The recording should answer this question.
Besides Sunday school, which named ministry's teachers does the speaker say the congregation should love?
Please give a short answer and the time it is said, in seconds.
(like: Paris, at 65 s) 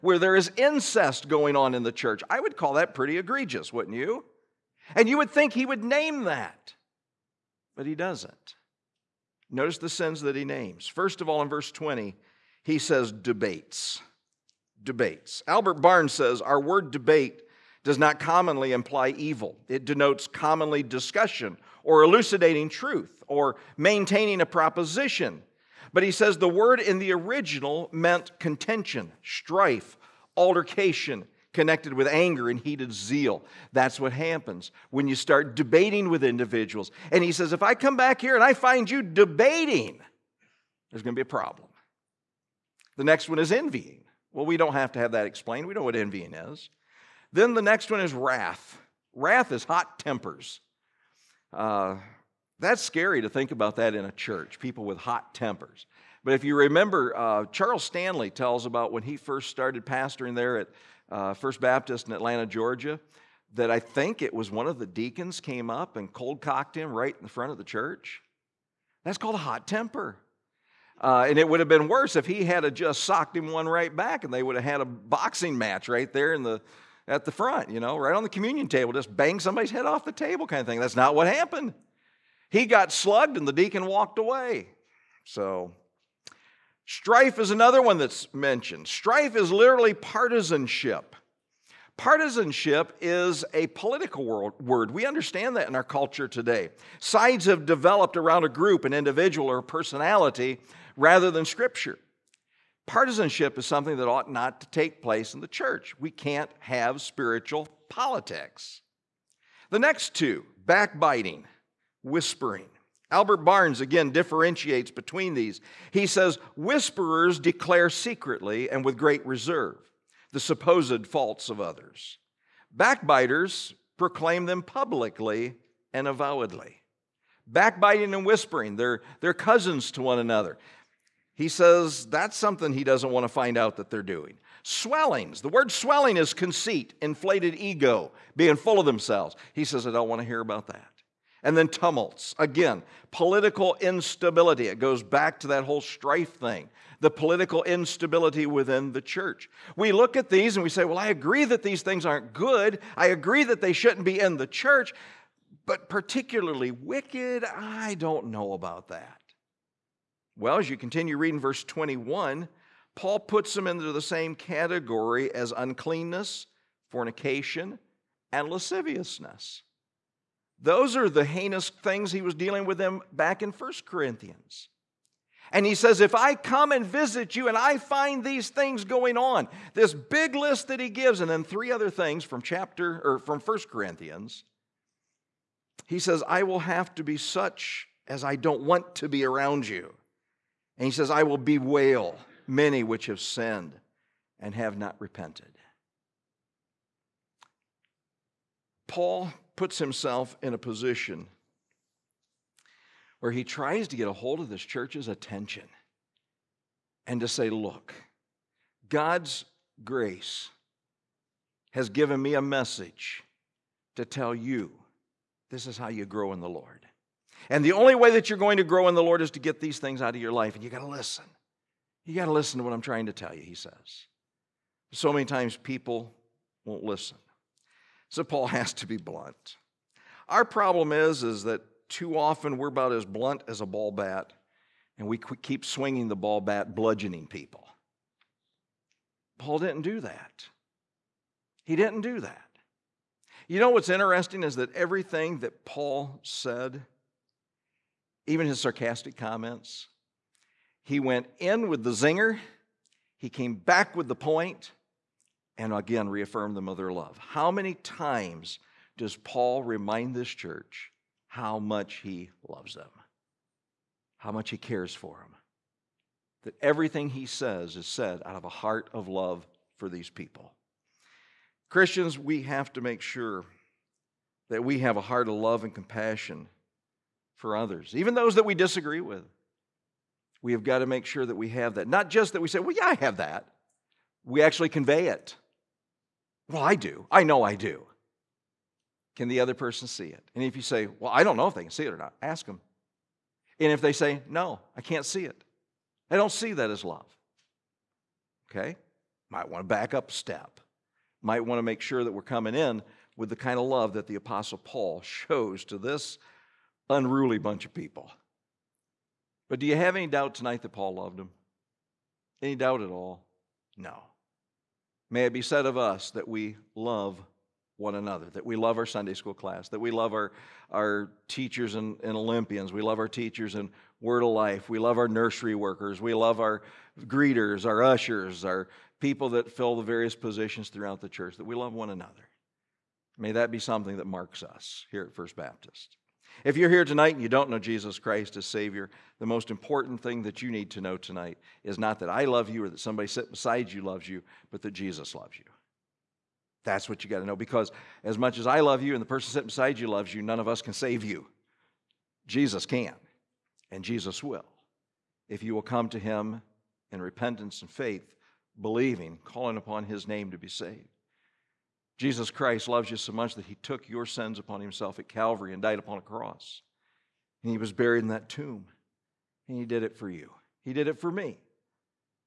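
Word of Life, at 324 s.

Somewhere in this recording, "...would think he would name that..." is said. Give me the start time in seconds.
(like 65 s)
5 s.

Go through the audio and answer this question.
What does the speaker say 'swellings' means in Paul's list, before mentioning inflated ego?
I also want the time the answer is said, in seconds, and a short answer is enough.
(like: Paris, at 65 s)
Conceit, at 136 s.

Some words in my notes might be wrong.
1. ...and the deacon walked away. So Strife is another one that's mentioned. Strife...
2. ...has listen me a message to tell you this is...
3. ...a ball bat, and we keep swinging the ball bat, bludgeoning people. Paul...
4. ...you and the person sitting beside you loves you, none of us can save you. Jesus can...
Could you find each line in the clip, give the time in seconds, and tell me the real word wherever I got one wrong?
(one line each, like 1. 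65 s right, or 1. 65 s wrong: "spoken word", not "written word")
1. 83 s right
2. 211 s wrong: "given", not "listen"
3. 233 s right
4. 348 s right.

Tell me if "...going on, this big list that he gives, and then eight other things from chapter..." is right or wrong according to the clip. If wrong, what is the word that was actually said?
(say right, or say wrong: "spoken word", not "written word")
wrong: "three", not "eight".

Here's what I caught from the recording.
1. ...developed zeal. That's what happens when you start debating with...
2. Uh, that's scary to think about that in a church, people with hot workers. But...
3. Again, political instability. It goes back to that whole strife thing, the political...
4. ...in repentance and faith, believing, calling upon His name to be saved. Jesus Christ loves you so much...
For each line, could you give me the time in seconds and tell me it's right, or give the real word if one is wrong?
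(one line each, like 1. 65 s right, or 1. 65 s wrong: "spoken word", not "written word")
1. 32 s wrong: "heated", not "developed"
2. 51 s wrong: "tempers", not "workers"
3. 142 s right
4. 356 s right.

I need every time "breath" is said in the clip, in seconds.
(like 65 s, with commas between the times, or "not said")
not said.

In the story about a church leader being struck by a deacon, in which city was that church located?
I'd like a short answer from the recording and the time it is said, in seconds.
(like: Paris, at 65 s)
Atlanta, Georgia, at 62 s.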